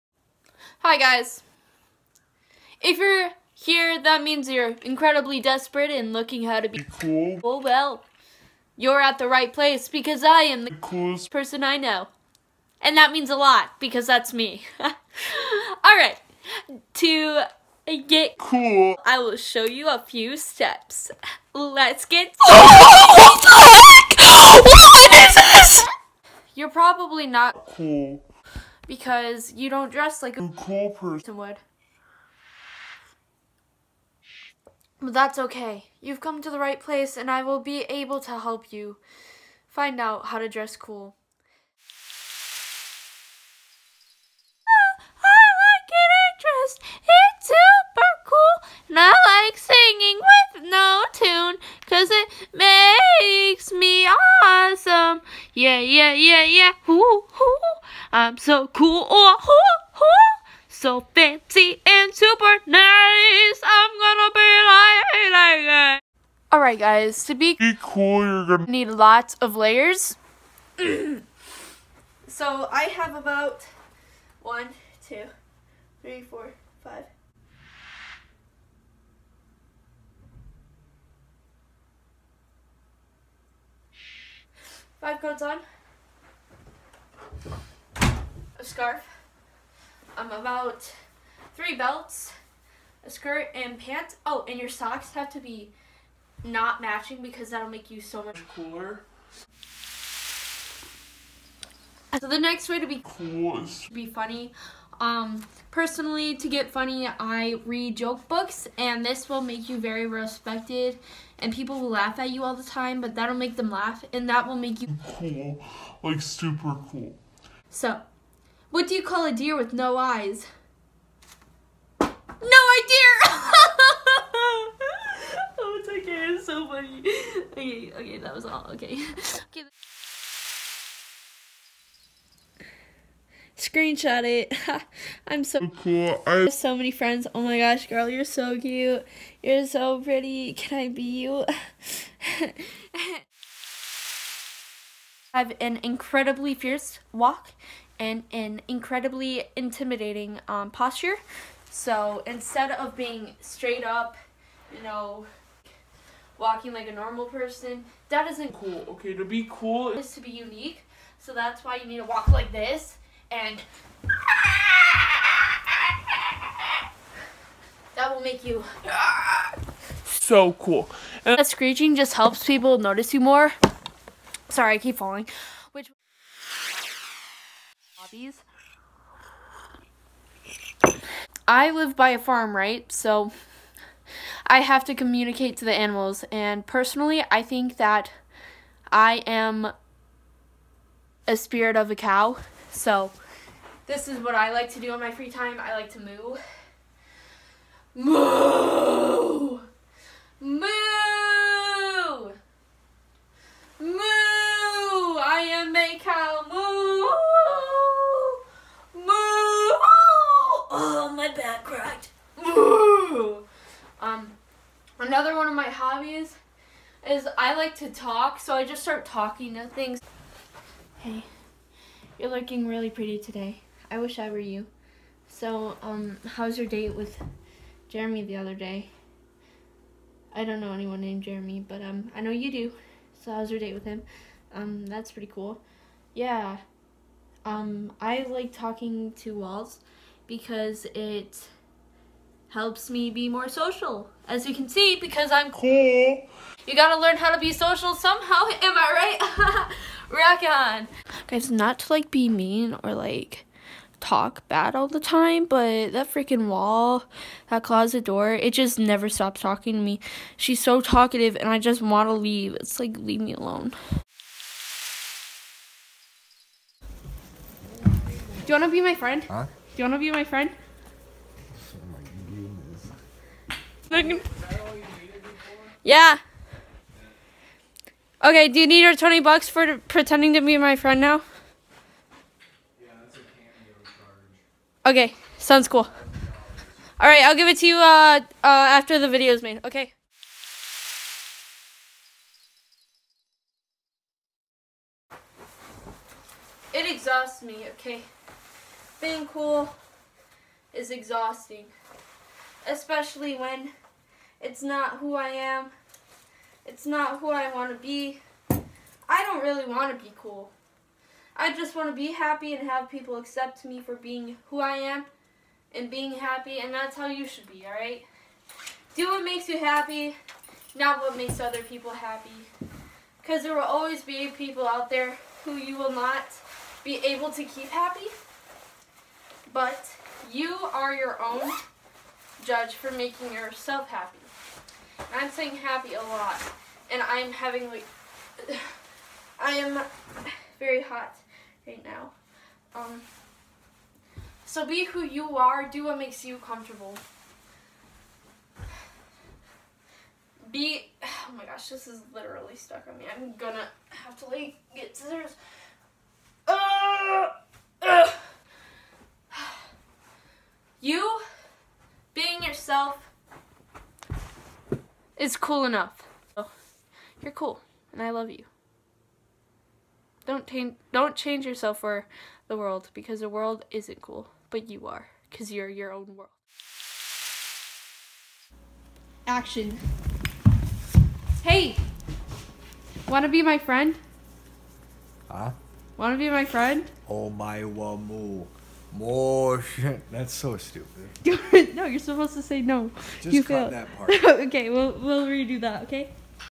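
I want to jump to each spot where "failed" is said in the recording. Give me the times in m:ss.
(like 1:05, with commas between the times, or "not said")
6:33.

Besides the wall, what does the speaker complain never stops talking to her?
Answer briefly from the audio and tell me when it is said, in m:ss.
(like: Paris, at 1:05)
closet door, at 4:17.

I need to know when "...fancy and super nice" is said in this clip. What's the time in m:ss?
1:01.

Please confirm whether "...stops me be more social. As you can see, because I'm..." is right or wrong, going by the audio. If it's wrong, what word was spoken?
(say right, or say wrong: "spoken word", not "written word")
wrong: "helps", not "stops".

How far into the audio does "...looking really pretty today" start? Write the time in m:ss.
3:42.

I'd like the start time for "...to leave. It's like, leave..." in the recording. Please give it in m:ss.
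4:22.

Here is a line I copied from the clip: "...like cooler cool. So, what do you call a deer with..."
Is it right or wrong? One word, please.
wrong.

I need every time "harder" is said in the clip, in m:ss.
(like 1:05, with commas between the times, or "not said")
not said.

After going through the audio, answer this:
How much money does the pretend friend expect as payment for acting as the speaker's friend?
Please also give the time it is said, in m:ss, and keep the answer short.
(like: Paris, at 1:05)
20 bucks, at 4:38.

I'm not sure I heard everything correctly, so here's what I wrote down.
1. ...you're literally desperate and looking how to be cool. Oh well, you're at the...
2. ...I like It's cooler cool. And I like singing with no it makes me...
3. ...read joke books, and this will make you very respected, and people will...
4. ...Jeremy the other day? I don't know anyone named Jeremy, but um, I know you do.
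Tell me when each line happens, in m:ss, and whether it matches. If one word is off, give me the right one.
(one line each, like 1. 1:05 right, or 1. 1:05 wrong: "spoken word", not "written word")
1. 0:04 wrong: "incredibly", not "literally"
2. 0:45 wrong: "super", not "cooler"
3. 1:47 right
4. 3:47 right.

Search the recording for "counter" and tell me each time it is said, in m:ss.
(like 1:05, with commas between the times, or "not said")
not said.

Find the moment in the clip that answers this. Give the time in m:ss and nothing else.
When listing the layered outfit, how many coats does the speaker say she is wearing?
1:24.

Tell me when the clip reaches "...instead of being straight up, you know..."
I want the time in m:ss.
2:32.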